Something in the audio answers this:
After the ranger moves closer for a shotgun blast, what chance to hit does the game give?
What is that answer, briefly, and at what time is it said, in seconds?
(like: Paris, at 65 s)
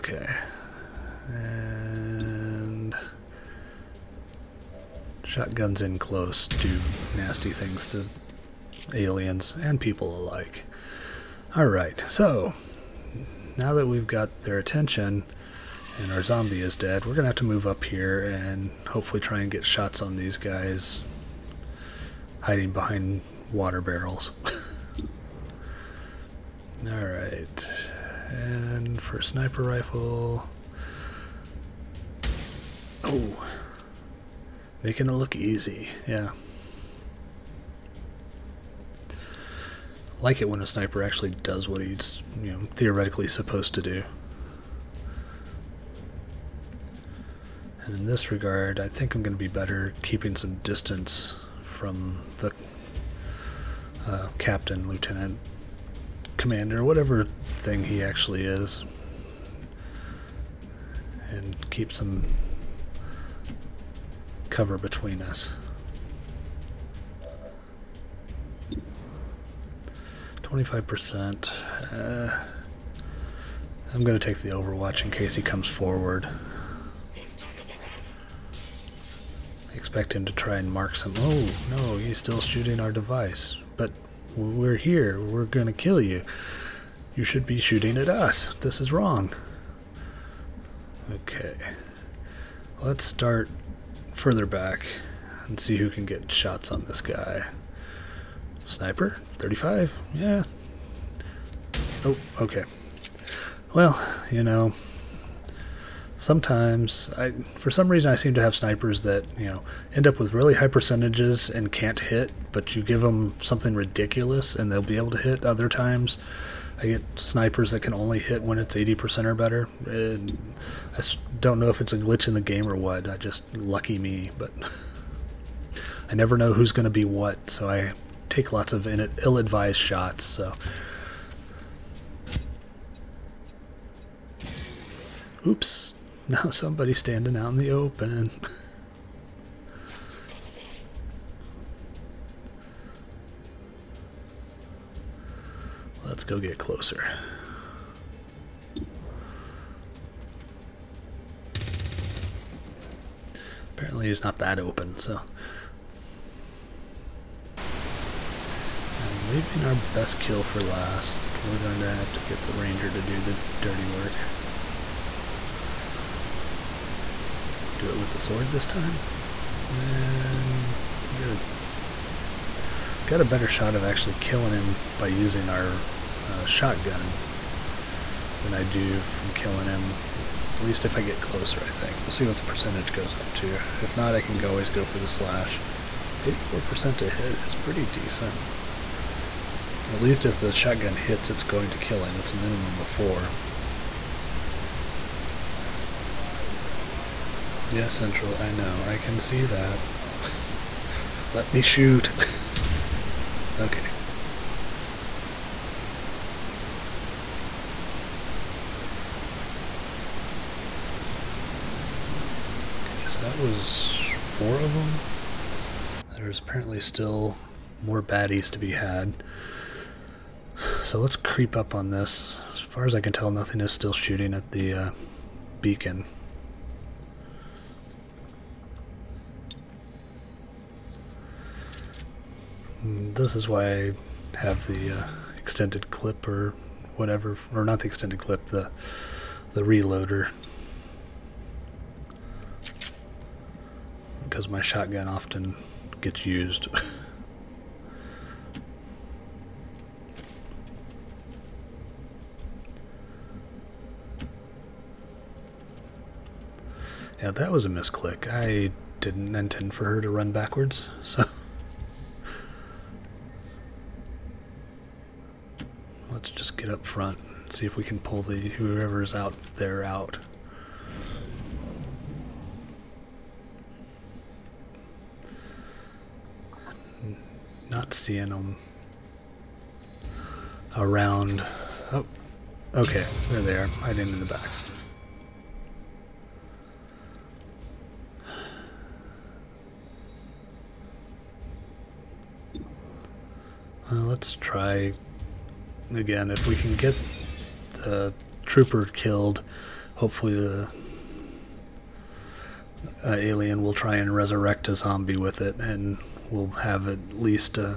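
84%, at 186 s.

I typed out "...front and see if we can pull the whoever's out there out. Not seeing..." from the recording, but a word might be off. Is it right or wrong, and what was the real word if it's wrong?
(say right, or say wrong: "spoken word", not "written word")
right.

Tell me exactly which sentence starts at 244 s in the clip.
Because my shotgun often gets used.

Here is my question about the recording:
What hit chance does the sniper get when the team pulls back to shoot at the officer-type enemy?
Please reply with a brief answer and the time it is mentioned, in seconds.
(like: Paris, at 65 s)
35, at 99 s.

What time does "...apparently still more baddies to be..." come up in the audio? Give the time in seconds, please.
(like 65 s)
216 s.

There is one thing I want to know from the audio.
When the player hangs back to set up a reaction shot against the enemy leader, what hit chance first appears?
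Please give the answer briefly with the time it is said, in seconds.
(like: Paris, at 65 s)
25%, at 70 s.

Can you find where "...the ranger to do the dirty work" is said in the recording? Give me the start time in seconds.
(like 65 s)
162 s.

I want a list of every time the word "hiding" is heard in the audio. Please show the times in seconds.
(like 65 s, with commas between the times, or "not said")
22 s.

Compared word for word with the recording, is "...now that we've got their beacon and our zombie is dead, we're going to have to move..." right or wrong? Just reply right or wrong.
wrong.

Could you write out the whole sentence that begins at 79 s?
Expect him to try and mark some.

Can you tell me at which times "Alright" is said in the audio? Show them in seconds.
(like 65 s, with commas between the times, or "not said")
11 s, 26 s.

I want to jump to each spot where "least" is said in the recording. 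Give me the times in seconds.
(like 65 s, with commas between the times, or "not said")
180 s, 189 s, 307 s.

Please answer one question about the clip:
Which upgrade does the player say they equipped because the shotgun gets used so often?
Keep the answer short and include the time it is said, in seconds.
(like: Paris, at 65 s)
the reloader, at 239 s.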